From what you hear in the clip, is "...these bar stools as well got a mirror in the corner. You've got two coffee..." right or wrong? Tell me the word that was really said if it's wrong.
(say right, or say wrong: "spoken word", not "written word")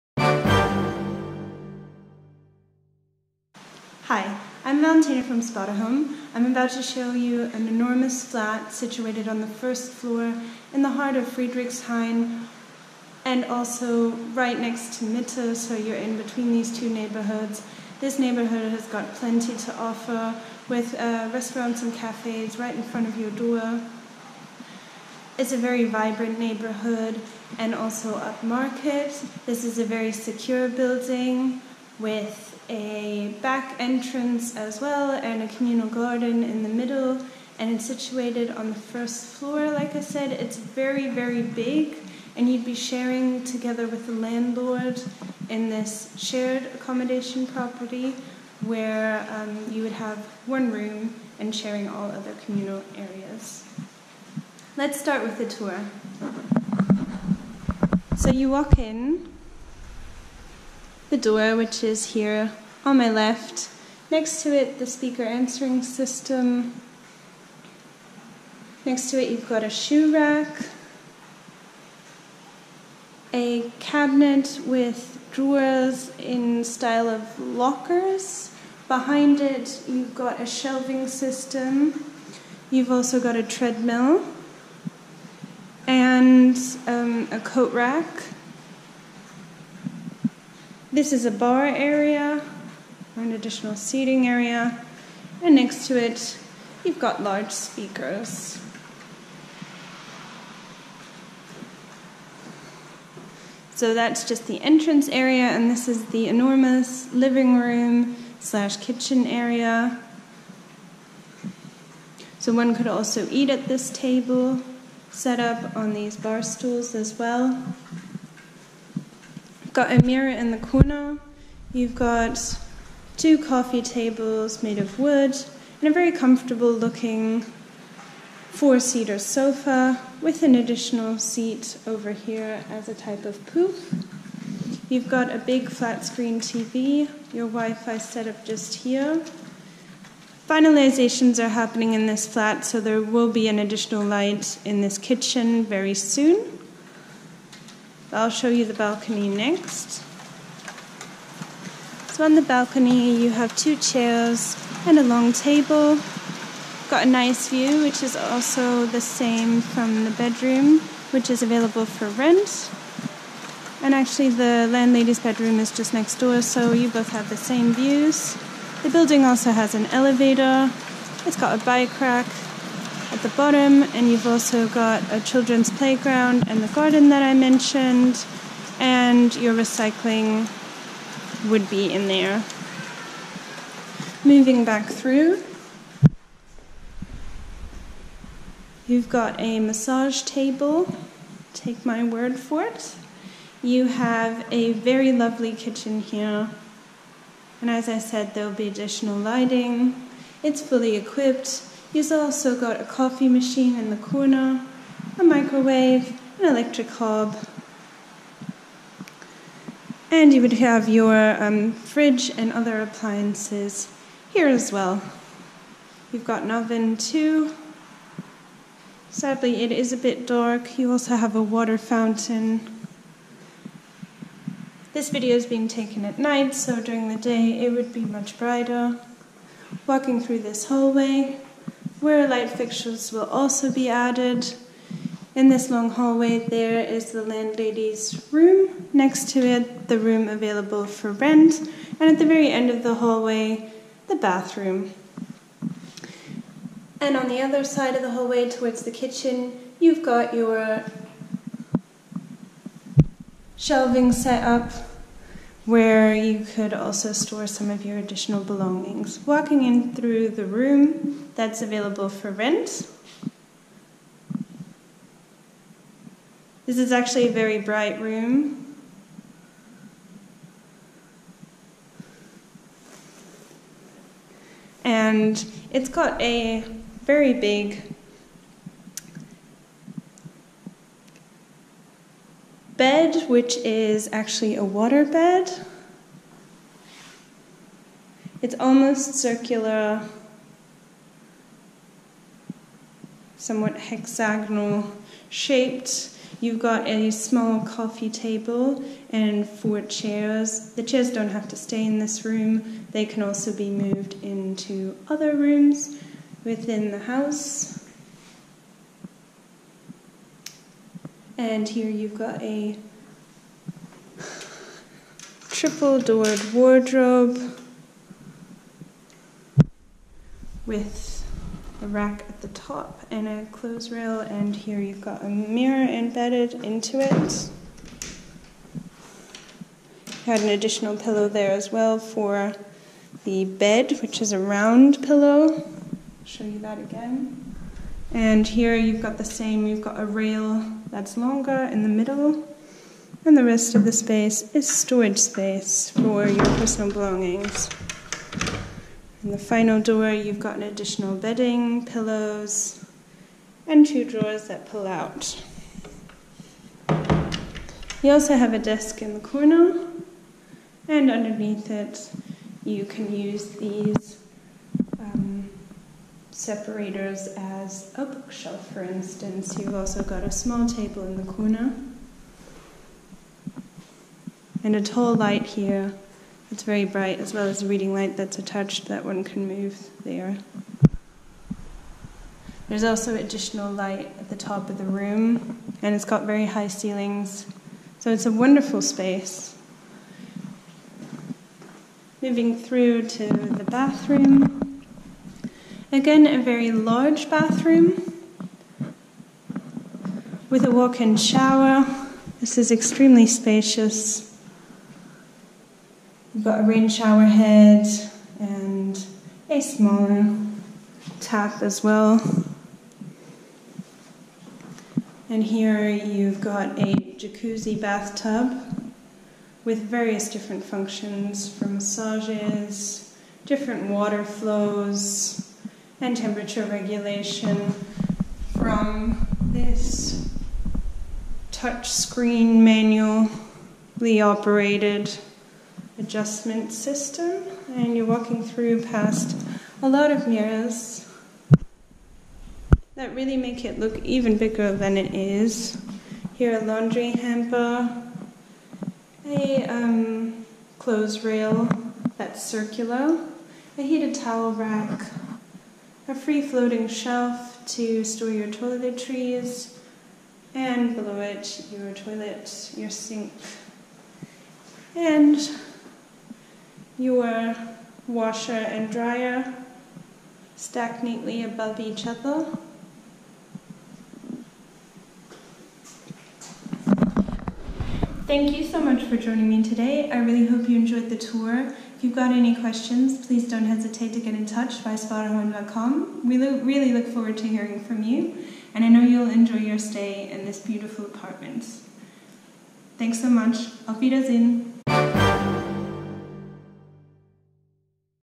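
right.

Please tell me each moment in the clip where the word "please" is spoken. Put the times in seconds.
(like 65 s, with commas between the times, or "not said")
483 s.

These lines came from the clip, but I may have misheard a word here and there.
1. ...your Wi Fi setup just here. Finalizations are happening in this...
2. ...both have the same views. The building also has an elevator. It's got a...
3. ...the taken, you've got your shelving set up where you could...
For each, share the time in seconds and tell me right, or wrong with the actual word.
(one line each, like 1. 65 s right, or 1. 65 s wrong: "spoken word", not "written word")
1. 137 s right
2. 166 s right
3. 248 s wrong: "kitchen", not "taken".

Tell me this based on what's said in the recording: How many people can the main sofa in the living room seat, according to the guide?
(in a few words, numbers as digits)
4.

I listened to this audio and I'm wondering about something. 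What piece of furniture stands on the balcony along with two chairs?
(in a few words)
Long table.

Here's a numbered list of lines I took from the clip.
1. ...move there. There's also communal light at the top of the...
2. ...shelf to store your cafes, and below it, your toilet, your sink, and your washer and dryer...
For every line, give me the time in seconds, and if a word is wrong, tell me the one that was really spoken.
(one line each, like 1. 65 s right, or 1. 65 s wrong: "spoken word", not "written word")
1. 379 s wrong: "additional", not "communal"
2. 456 s wrong: "toiletries", not "cafes".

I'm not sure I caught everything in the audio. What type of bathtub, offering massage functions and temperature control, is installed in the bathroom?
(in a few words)
Jacuzzi bathtub.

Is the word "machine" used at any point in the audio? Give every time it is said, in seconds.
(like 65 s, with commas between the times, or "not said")
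203 s.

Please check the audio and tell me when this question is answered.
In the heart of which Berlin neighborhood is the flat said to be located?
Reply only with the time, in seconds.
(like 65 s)
11 s.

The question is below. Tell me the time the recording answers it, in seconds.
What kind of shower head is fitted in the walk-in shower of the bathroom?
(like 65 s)
406 s.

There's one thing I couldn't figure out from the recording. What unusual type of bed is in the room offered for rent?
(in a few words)
Water bed.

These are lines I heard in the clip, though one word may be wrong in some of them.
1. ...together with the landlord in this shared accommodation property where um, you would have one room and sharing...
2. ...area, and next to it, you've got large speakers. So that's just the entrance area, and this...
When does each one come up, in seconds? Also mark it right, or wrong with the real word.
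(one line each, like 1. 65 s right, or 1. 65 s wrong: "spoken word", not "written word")
1. 43 s right
2. 94 s right.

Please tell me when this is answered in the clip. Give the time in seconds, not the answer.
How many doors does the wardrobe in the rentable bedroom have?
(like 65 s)
315 s.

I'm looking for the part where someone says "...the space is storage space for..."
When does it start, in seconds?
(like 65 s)
343 s.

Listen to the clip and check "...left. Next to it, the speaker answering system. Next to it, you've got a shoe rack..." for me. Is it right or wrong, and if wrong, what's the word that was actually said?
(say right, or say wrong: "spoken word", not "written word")
right.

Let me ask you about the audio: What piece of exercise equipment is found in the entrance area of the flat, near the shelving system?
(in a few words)
Treadmill.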